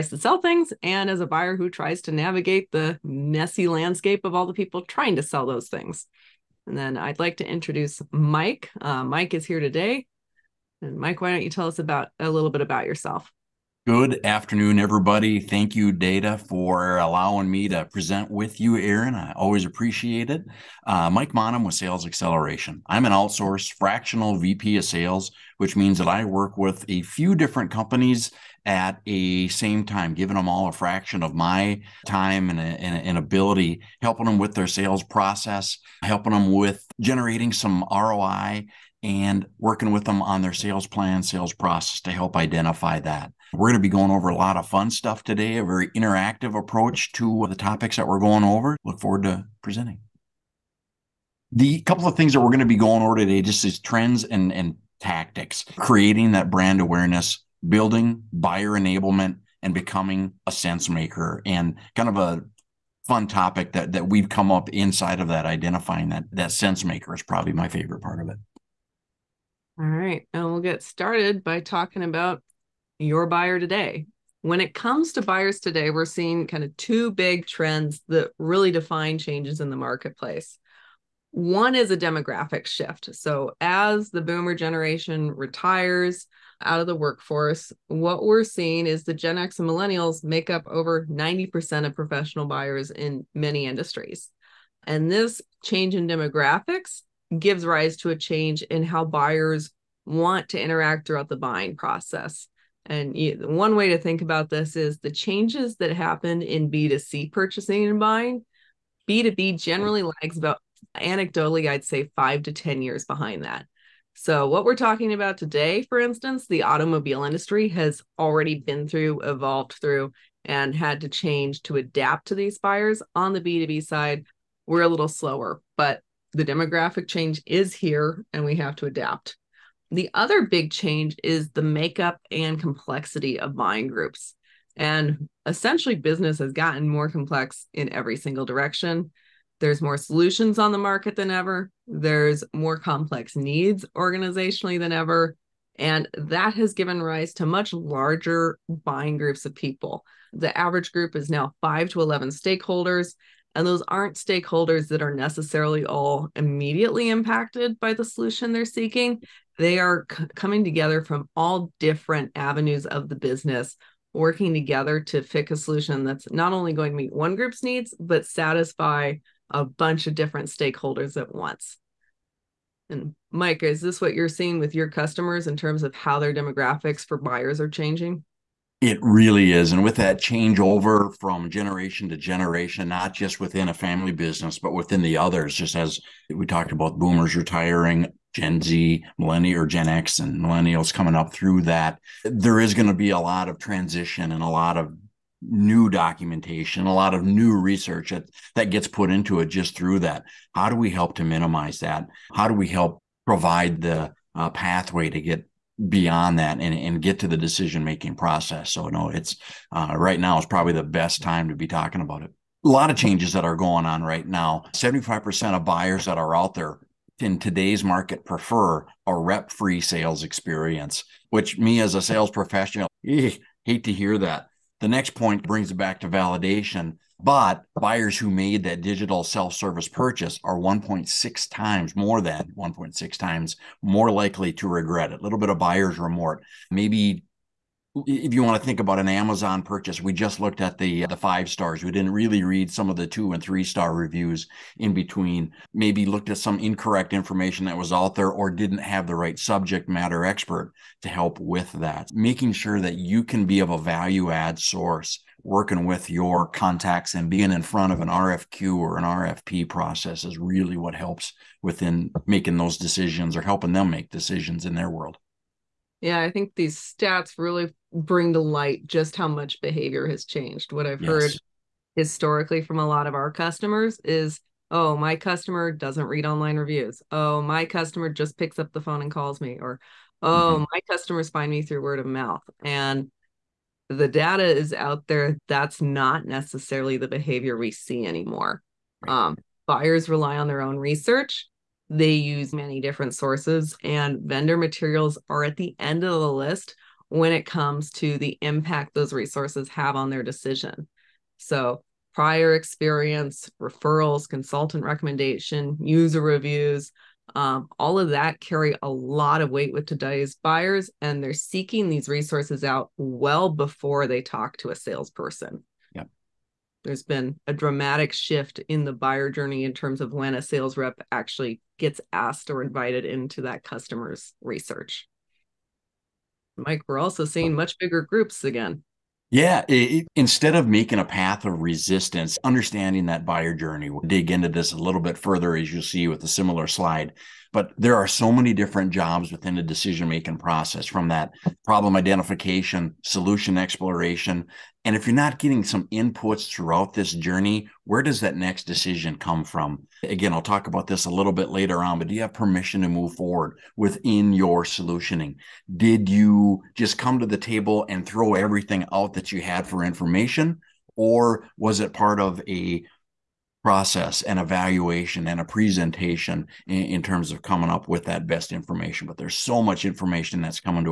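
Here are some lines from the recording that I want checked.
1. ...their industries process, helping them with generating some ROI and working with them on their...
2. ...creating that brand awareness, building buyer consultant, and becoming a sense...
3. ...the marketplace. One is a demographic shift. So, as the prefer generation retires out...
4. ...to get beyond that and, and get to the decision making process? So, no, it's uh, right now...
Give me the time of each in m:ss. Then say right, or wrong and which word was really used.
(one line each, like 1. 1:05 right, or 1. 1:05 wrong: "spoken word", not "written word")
1. 0:34 wrong: "sales", not "industries"
2. 0:55 wrong: "enablement", not "consultant"
3. 1:19 wrong: "boomer", not "prefer"
4. 3:25 right.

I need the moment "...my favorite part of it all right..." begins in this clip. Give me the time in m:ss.
1:07.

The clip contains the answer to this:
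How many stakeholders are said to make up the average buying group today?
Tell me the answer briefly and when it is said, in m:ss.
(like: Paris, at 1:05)
5 to 11, at 2:31.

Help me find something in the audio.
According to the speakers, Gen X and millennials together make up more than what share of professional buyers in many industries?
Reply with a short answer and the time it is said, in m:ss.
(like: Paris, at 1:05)
90%, at 1:30.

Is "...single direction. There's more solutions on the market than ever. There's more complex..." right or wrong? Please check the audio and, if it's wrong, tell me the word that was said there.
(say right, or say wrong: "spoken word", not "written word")
right.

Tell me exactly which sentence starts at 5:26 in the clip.
Mike, we're also seeing much bigger groups again.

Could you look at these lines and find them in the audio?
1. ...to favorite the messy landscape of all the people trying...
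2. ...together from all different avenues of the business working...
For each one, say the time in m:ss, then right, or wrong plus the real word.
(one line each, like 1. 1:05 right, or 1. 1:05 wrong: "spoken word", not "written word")
1. 0:02 wrong: "navigate", not "favorite"
2. 2:40 right.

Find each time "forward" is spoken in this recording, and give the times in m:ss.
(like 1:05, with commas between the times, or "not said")
0:48, 5:53.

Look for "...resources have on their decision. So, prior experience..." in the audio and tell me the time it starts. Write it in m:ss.
4:59.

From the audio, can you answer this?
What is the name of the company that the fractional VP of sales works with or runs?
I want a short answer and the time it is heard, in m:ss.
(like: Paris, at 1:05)
Sales Acceleration, at 0:21.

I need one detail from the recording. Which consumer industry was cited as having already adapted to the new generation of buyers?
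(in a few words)
automobile industry.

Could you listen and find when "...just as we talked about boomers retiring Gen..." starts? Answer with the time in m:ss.
3:05.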